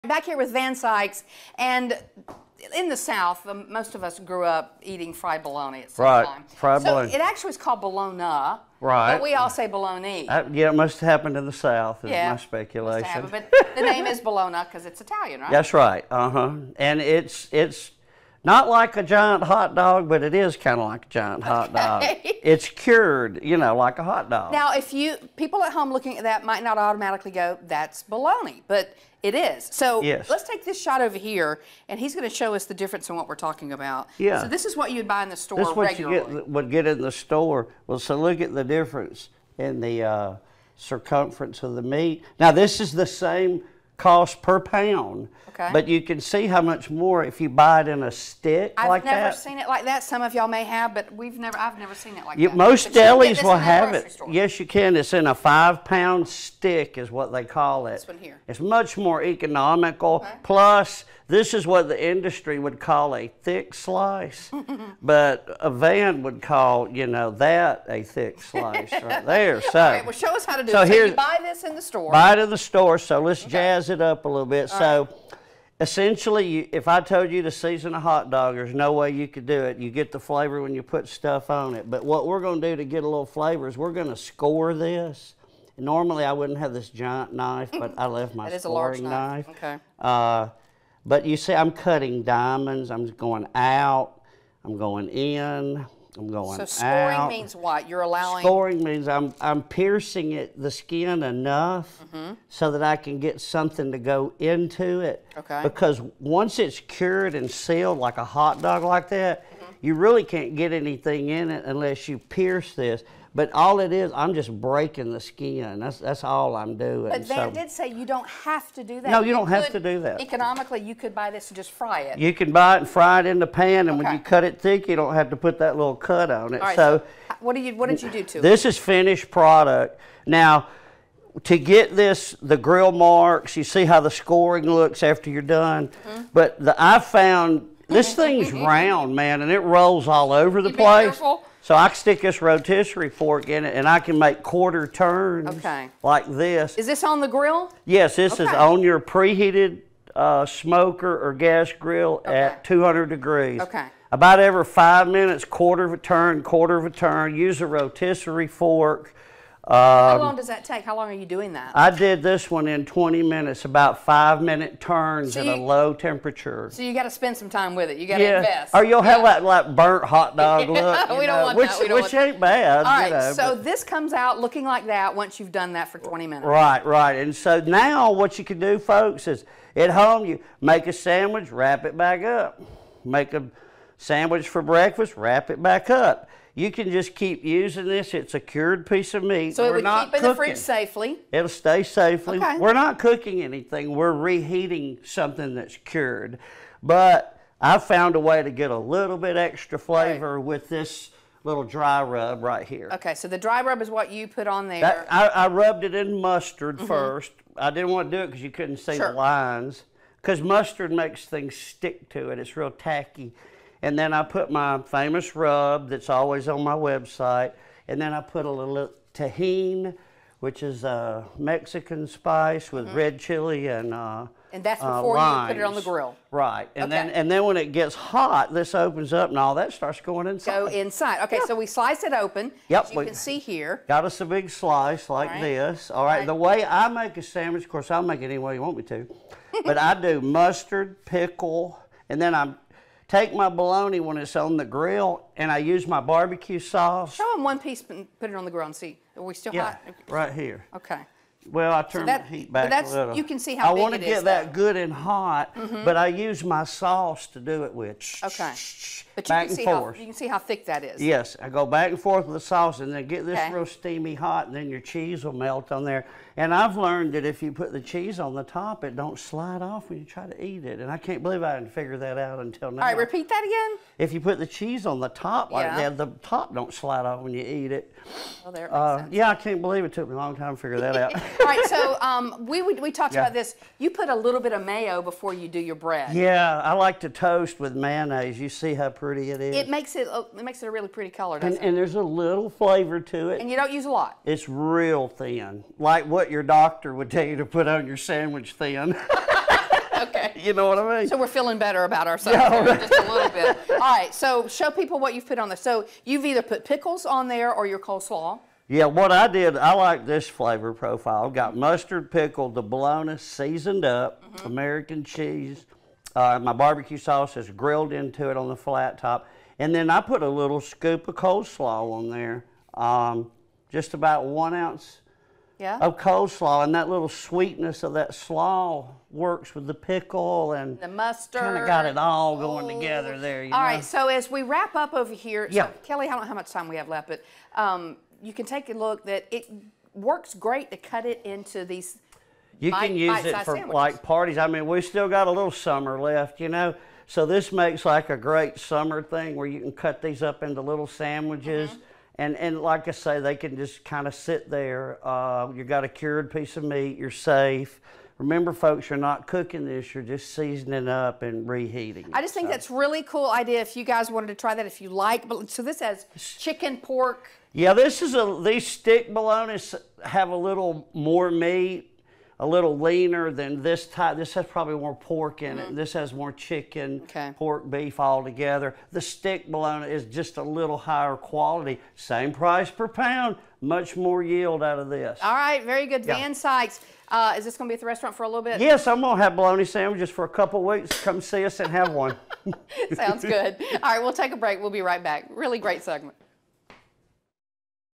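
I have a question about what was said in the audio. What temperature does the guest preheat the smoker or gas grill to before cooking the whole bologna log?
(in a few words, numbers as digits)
200 degrees.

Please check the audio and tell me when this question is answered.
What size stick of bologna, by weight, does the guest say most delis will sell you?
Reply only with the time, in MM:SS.
00:55.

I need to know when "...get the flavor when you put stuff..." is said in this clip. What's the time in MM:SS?
01:19.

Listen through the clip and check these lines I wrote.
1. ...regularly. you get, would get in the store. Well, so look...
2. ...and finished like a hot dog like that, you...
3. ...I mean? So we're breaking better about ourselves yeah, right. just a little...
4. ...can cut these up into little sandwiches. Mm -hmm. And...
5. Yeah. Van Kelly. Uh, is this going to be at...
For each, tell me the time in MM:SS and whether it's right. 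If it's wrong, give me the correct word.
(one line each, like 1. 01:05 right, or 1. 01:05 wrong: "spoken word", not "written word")
1. 00:35 right
2. 01:47 wrong: "sealed", not "finished"
3. 05:00 wrong: "feeling", not "breaking"
4. 05:49 right
5. 06:26 wrong: "Sykes", not "Kelly".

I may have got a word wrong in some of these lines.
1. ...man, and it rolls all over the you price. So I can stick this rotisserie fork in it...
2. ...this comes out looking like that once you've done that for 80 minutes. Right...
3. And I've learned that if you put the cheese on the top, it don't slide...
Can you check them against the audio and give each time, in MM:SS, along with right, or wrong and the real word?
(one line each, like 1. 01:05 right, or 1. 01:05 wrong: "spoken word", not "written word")
1. 02:19 wrong: "place", not "price"
2. 02:53 wrong: "20", not "80"
3. 04:26 right.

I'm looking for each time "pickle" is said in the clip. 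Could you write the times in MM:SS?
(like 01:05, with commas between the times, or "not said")
04:01, 05:06, 05:12, 05:29.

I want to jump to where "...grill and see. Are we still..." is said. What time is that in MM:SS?
04:08.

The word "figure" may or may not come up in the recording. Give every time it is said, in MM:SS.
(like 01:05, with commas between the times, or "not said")
04:31, 04:40.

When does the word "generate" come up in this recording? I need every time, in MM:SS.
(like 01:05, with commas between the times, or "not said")
not said.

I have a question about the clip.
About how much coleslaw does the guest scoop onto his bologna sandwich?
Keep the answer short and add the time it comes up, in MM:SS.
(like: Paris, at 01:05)
1 ounce, at 05:24.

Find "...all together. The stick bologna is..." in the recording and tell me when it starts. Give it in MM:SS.
06:17.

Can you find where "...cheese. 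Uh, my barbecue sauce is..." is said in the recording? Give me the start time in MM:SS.
05:15.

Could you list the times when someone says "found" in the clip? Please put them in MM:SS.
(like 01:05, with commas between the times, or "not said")
02:16, 03:17.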